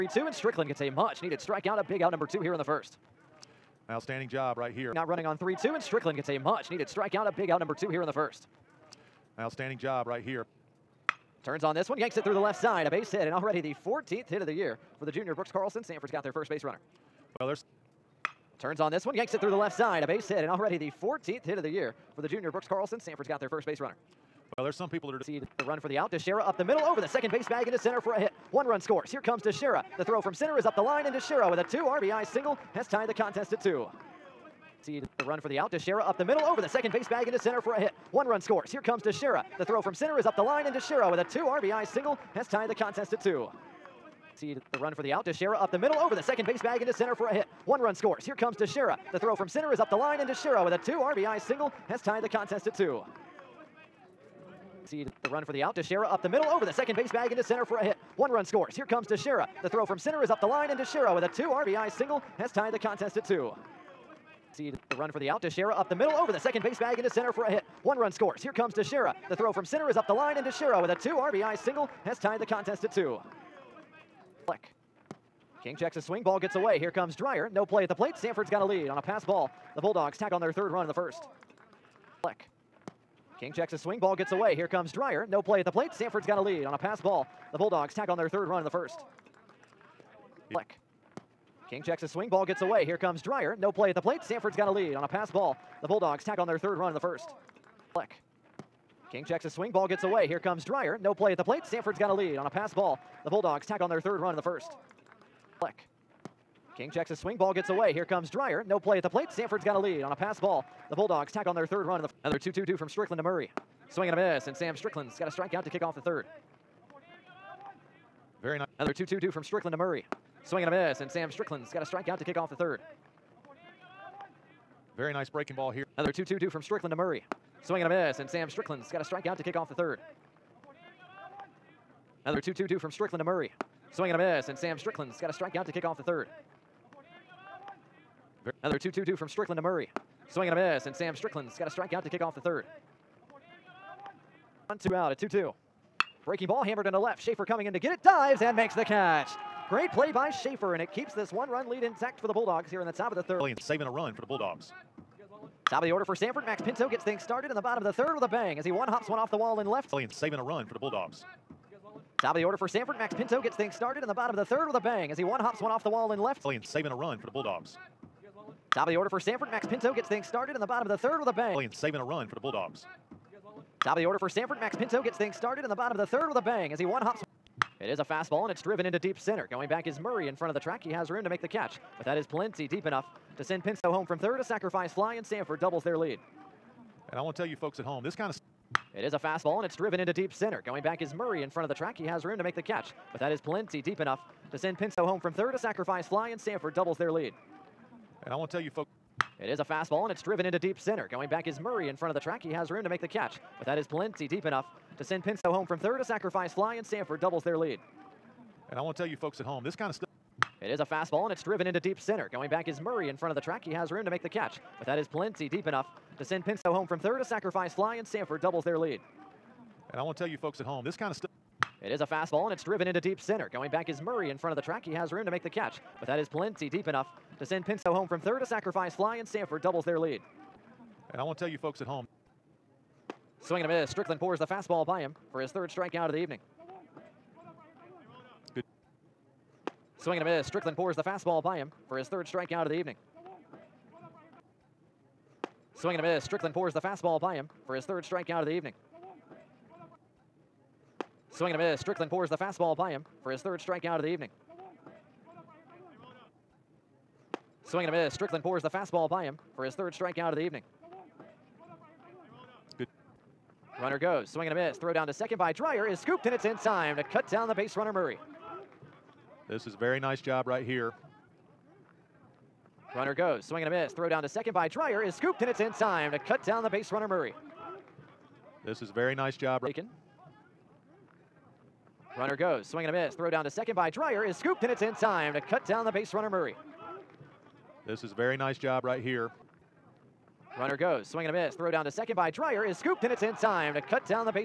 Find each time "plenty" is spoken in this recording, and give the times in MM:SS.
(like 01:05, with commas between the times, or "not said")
03:02, 03:13, 03:23, 03:35, 03:46.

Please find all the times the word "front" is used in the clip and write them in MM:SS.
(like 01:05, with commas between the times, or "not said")
03:00, 03:11, 03:21, 03:33, 03:44.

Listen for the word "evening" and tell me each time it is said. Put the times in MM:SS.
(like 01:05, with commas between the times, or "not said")
03:56, 04:02, 04:08, 04:14, 04:20.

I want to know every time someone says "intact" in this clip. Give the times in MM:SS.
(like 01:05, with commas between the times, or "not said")
02:31.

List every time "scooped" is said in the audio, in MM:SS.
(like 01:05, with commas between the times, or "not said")
04:25, 04:35, 04:44, 04:52.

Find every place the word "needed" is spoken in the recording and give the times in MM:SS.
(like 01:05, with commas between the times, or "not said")
00:00, 00:06.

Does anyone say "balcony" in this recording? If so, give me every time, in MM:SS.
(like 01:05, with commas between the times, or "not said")
not said.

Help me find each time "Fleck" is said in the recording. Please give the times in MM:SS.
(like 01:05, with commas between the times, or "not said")
01:30, 01:37, 01:45.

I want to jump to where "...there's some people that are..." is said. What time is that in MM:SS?
00:24.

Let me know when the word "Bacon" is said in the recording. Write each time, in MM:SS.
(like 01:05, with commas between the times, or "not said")
04:39.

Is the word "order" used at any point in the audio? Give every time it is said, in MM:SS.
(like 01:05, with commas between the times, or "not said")
02:35, 02:42, 02:48, 02:54.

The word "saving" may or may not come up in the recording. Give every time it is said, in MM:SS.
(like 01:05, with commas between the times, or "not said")
02:33, 02:40, 02:46, 02:51.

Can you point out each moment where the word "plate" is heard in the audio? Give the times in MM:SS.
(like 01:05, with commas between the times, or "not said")
01:17, 01:25, 01:34, 01:41, 01:49.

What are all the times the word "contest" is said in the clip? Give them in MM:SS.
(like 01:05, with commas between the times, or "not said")
00:33, 00:42, 00:52, 01:02, 01:12.